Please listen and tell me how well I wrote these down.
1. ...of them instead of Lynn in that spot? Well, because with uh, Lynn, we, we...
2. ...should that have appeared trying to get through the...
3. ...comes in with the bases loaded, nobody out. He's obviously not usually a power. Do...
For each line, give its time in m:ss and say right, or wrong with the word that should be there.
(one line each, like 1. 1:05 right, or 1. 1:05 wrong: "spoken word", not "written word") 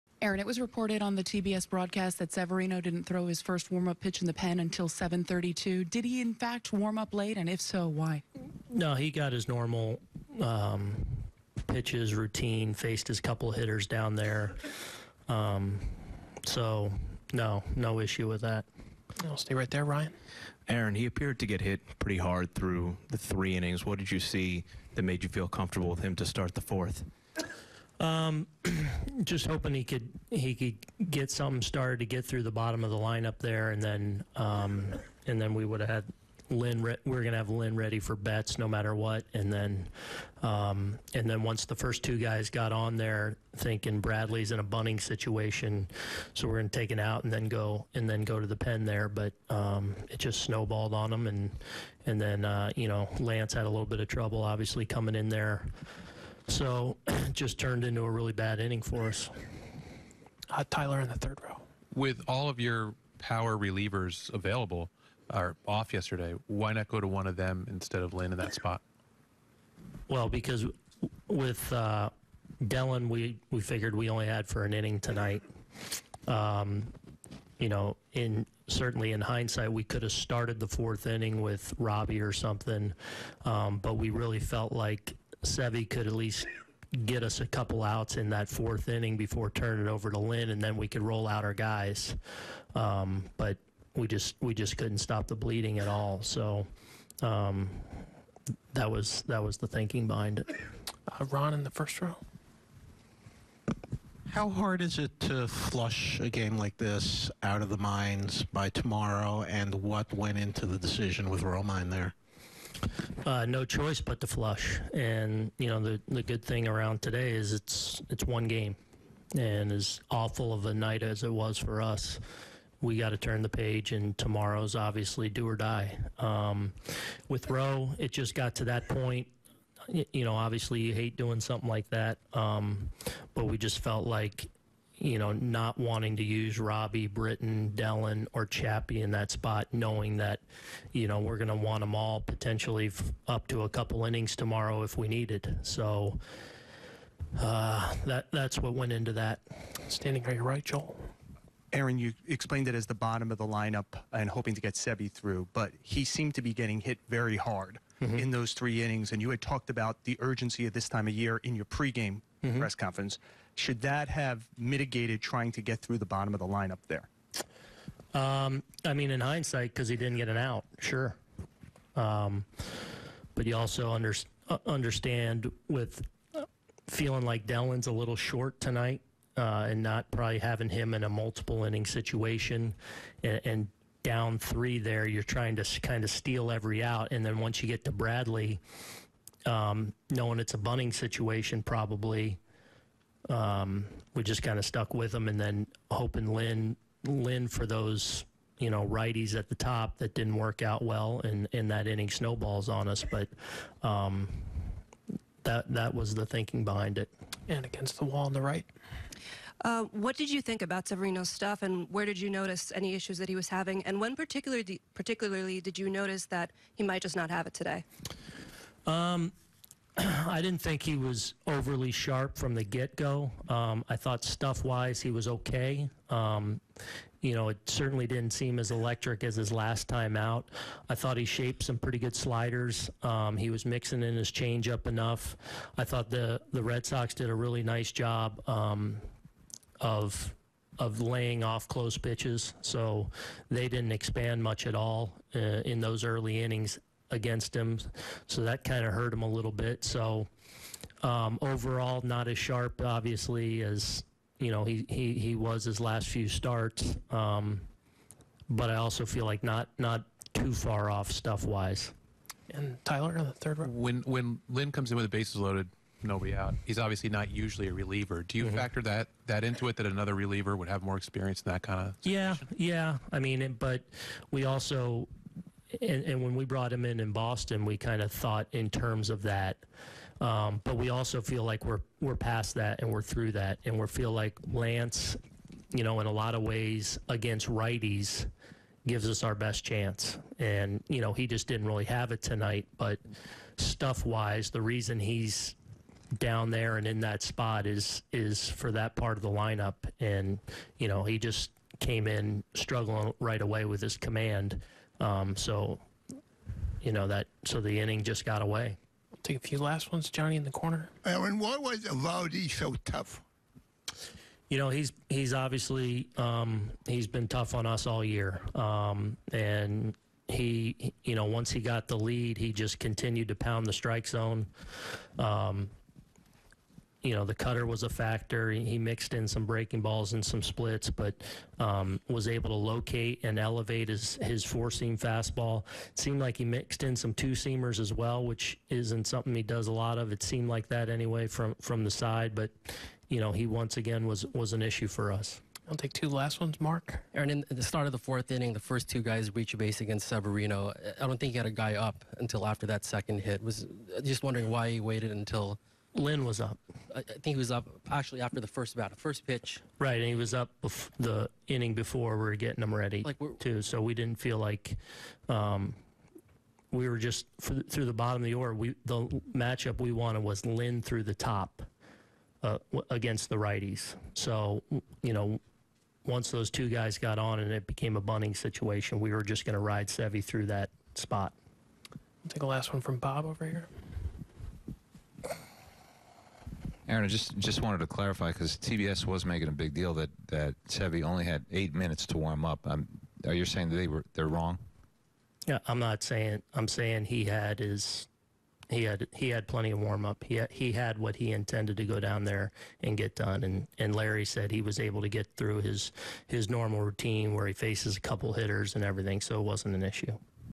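1. 1:07 wrong: "Dellen", not "Lynn"
2. 2:43 wrong: "mitigated", not "appeared"
3. 4:24 wrong: "reliever", not "power".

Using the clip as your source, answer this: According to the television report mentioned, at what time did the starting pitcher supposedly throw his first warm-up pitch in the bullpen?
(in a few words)
7:32.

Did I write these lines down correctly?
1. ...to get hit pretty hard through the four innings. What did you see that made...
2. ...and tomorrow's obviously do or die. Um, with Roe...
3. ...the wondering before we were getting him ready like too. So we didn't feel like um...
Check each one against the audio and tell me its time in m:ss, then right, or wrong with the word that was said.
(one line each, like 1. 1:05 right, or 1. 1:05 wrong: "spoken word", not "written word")
1. 0:21 wrong: "three", not "four"
2. 2:03 right
3. 6:00 wrong: "inning", not "wondering".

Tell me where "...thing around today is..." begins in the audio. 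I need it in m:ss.
1:56.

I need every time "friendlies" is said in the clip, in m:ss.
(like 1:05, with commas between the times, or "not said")
not said.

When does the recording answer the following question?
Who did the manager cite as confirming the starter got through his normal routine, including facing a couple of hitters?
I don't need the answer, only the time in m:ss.
6:43.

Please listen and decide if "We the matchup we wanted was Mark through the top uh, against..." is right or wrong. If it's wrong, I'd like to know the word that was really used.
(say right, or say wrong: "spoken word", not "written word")
wrong: "Lynn", not "Mark".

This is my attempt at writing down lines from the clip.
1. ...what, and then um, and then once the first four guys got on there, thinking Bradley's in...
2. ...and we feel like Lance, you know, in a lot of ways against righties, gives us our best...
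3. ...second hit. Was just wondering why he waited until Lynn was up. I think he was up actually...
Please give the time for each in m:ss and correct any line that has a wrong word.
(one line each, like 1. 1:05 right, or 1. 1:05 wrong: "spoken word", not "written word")
1. 0:38 wrong: "two", not "four"
2. 4:43 right
3. 5:52 right.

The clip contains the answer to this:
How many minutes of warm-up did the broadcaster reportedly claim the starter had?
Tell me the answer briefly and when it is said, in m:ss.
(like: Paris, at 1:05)
8, at 6:31.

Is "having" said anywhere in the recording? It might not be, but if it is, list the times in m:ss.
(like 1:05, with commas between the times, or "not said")
3:00, 3:33.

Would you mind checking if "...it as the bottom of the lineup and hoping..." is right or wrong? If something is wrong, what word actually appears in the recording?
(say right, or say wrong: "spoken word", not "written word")
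right.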